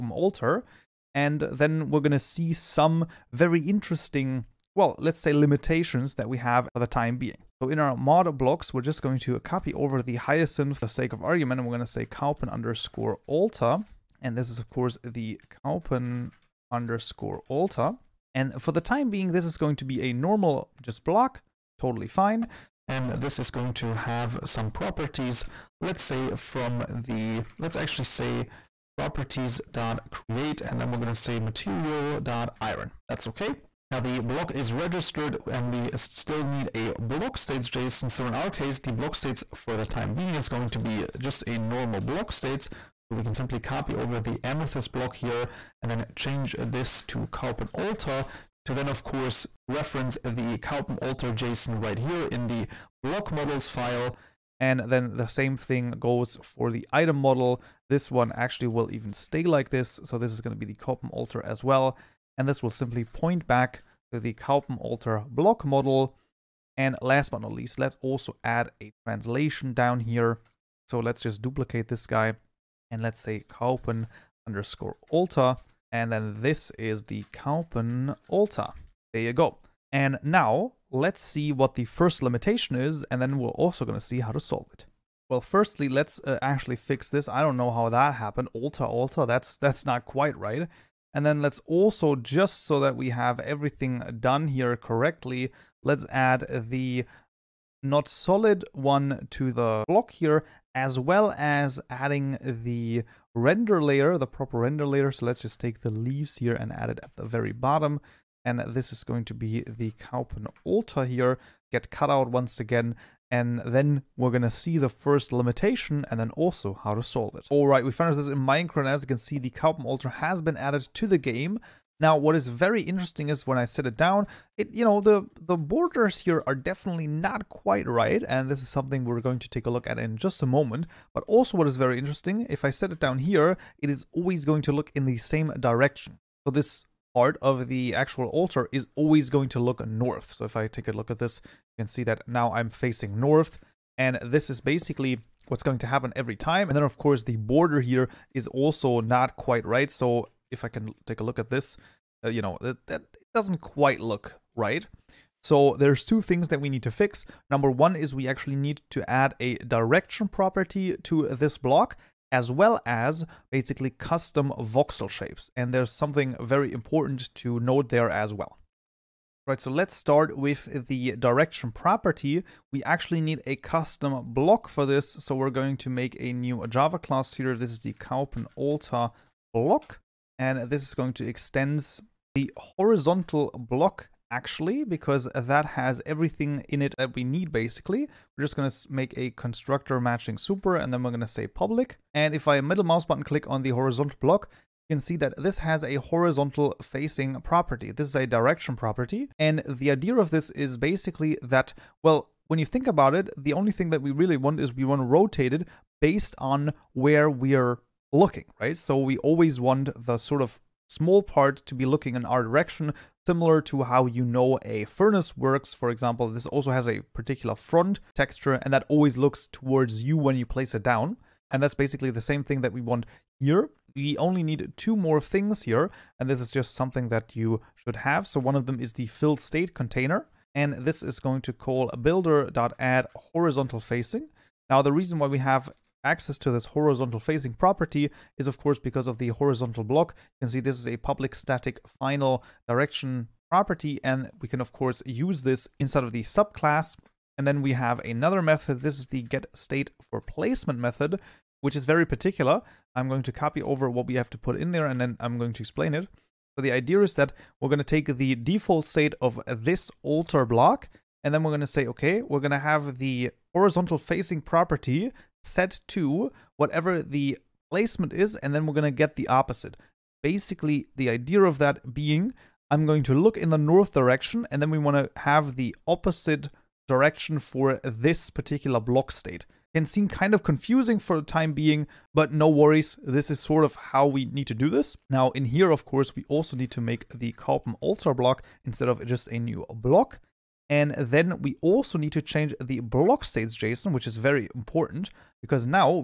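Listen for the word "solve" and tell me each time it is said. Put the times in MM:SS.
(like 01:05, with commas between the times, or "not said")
01:24, 01:57.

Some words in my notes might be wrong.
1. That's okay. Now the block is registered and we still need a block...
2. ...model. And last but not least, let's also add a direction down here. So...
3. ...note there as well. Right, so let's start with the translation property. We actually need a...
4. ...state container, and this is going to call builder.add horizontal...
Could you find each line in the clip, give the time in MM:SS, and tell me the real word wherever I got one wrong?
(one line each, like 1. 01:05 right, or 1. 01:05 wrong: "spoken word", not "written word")
1. 00:33 right
2. 01:05 wrong: "translation", not "direction"
3. 02:47 wrong: "direction", not "translation"
4. 03:49 right.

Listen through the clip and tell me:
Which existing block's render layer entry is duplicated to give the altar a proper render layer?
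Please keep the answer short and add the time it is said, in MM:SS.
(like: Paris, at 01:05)
Leaves, at 01:45.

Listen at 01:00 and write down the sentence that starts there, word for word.
So this is going to be the Kaupen altar as well.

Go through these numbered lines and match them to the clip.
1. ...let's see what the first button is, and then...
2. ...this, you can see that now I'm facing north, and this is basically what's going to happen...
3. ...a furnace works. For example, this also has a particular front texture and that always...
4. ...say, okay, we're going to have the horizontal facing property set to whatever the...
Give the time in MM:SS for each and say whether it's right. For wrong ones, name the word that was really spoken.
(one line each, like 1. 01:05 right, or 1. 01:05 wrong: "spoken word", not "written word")
1. 01:20 wrong: "limitation", not "button"
2. 02:21 right
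3. 03:34 right
4. 04:21 right.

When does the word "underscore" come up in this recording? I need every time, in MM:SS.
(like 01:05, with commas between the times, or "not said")
00:12, 00:16, 01:14.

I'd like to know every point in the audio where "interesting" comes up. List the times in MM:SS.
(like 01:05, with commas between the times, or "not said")
00:03, 02:02, 02:11.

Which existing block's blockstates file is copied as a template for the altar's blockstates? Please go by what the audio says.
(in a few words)
Amethyst block.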